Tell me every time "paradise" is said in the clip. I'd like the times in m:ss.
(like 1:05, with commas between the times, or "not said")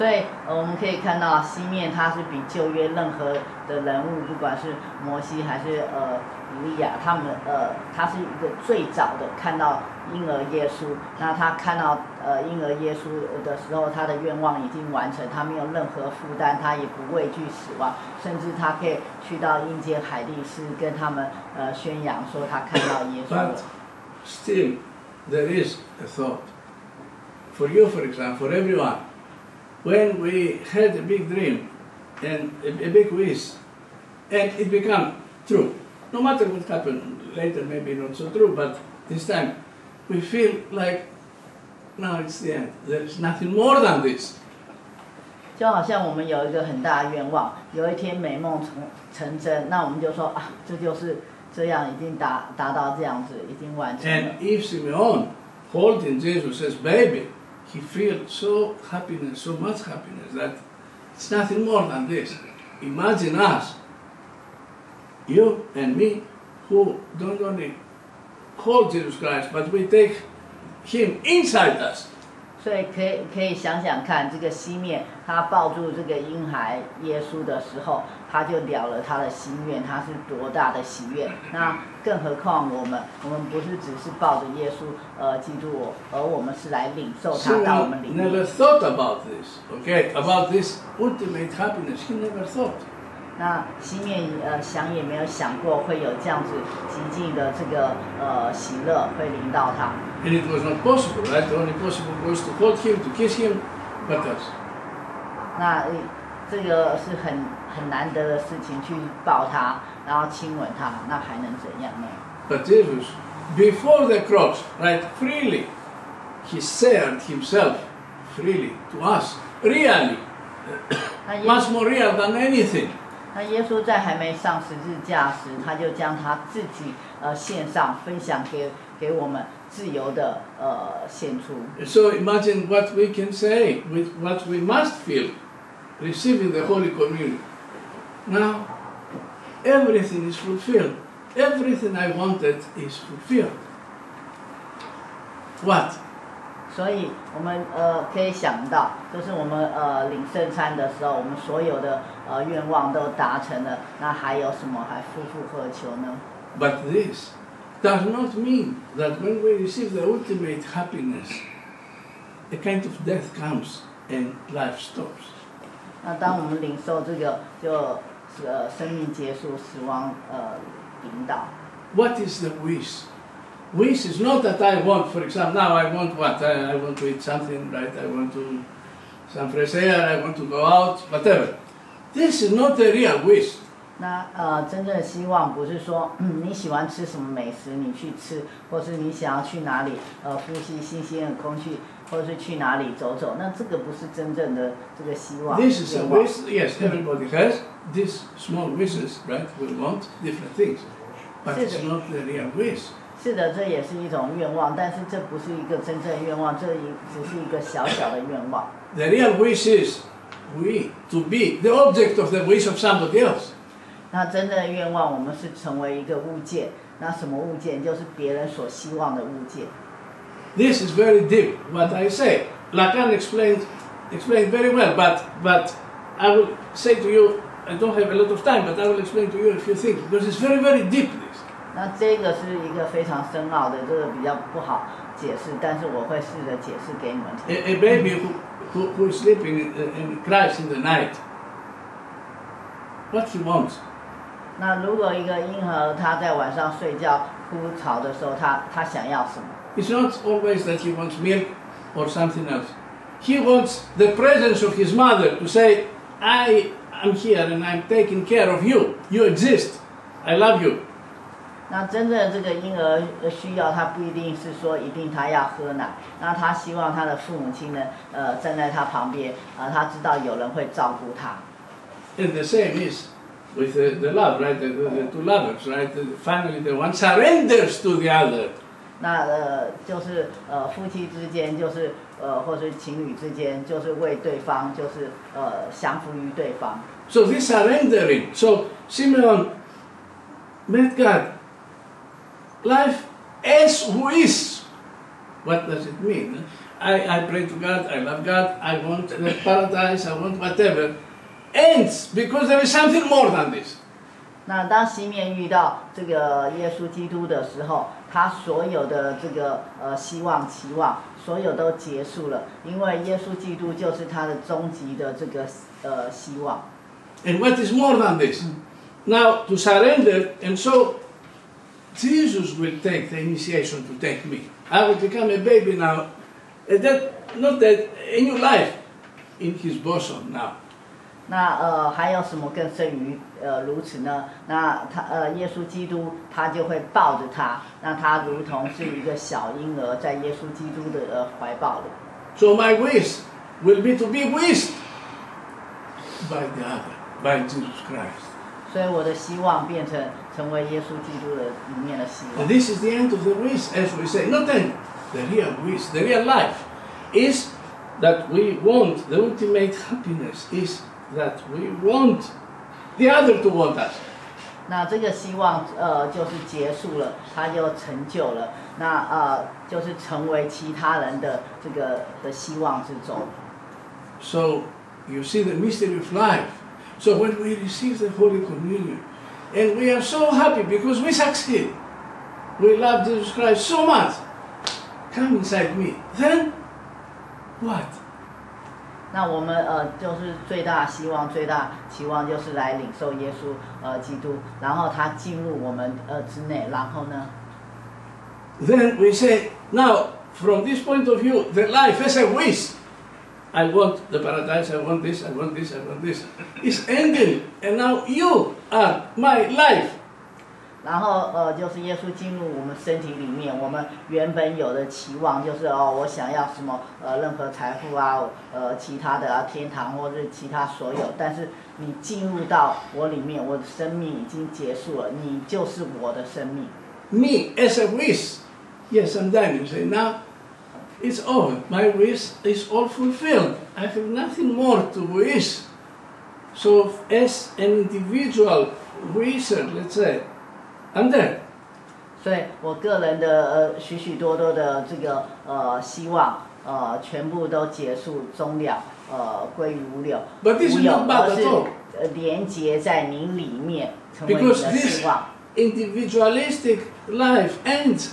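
4:59, 6:44.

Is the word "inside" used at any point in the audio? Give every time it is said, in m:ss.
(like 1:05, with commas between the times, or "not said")
1:11, 6:25.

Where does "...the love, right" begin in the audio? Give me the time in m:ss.
4:34.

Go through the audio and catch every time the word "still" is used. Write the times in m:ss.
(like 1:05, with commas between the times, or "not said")
0:24.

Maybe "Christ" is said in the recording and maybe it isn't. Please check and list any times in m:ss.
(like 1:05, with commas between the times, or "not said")
1:09, 5:47, 6:23.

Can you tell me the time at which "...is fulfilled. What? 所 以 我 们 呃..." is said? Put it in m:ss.
2:22.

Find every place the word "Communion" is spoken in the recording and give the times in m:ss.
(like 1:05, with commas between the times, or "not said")
2:16, 6:18.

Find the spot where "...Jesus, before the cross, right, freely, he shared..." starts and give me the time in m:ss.
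1:52.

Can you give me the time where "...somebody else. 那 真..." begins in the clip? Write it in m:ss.
3:32.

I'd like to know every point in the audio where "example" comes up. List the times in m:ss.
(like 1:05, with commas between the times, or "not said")
0:28, 2:55.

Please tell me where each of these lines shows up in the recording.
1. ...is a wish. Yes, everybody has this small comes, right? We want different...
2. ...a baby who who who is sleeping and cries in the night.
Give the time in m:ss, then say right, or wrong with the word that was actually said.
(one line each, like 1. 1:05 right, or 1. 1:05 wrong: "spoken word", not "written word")
1. 3:15 wrong: "wishes", not "comes"
2. 3:57 right.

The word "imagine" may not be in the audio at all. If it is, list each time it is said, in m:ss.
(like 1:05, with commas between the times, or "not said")
1:02, 2:12.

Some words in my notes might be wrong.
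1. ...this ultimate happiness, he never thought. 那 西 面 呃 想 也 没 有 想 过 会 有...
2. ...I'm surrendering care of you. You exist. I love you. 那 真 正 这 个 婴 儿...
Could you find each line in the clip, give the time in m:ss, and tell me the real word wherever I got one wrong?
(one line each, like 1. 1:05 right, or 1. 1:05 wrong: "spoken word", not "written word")
1. 1:30 right
2. 4:17 wrong: "taking", not "surrendering".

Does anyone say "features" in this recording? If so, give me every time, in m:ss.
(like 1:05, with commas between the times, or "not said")
not said.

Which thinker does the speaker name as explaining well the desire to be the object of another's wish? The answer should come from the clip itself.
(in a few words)
Lacan.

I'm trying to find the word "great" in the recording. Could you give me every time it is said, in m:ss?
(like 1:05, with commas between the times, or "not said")
not said.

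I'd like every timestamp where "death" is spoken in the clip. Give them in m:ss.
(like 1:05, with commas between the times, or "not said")
2:43.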